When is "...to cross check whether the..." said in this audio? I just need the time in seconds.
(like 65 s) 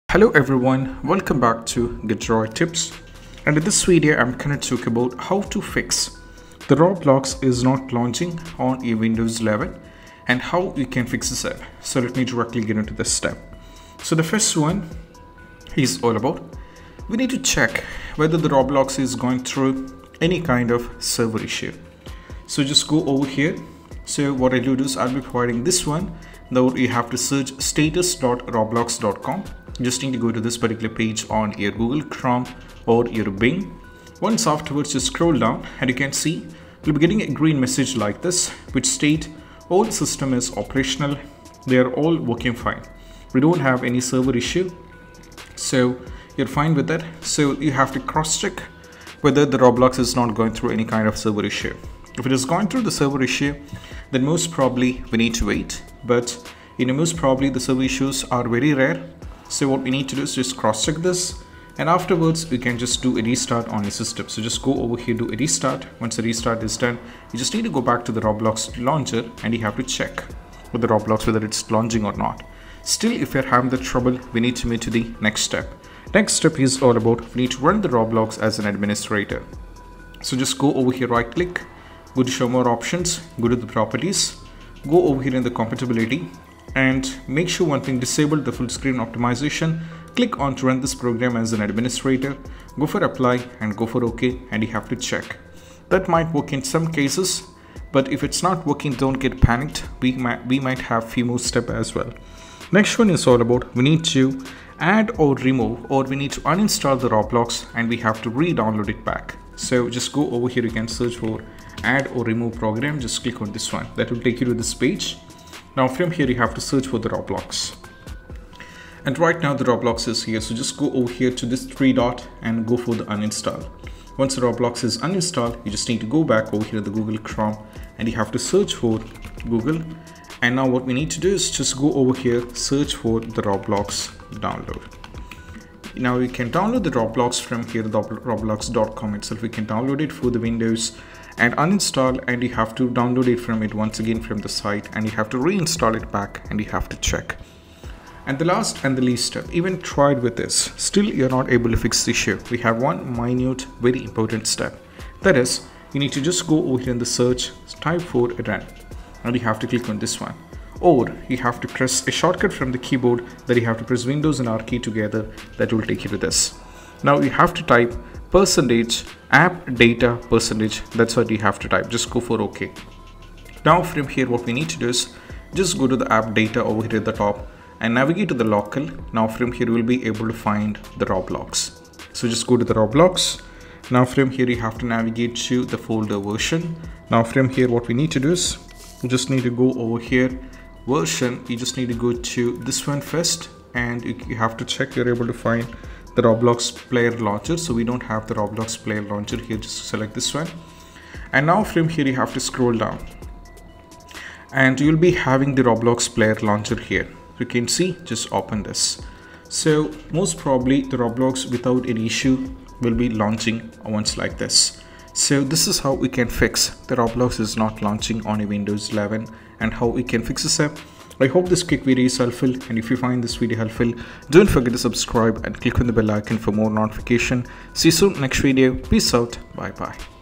47 s.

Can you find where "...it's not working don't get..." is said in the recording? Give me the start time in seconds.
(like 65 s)
98 s.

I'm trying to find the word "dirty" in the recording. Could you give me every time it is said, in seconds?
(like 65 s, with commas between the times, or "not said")
not said.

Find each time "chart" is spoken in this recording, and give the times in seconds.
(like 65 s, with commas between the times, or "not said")
not said.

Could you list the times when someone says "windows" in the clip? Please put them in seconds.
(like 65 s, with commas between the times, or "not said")
8 s, 140 s, 164 s, 218 s.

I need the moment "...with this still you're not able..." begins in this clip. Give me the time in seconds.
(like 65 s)
150 s.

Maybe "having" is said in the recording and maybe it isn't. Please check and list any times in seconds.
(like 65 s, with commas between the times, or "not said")
73 s, 205 s.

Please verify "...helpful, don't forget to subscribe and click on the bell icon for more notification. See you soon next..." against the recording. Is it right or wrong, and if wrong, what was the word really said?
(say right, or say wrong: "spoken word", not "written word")
right.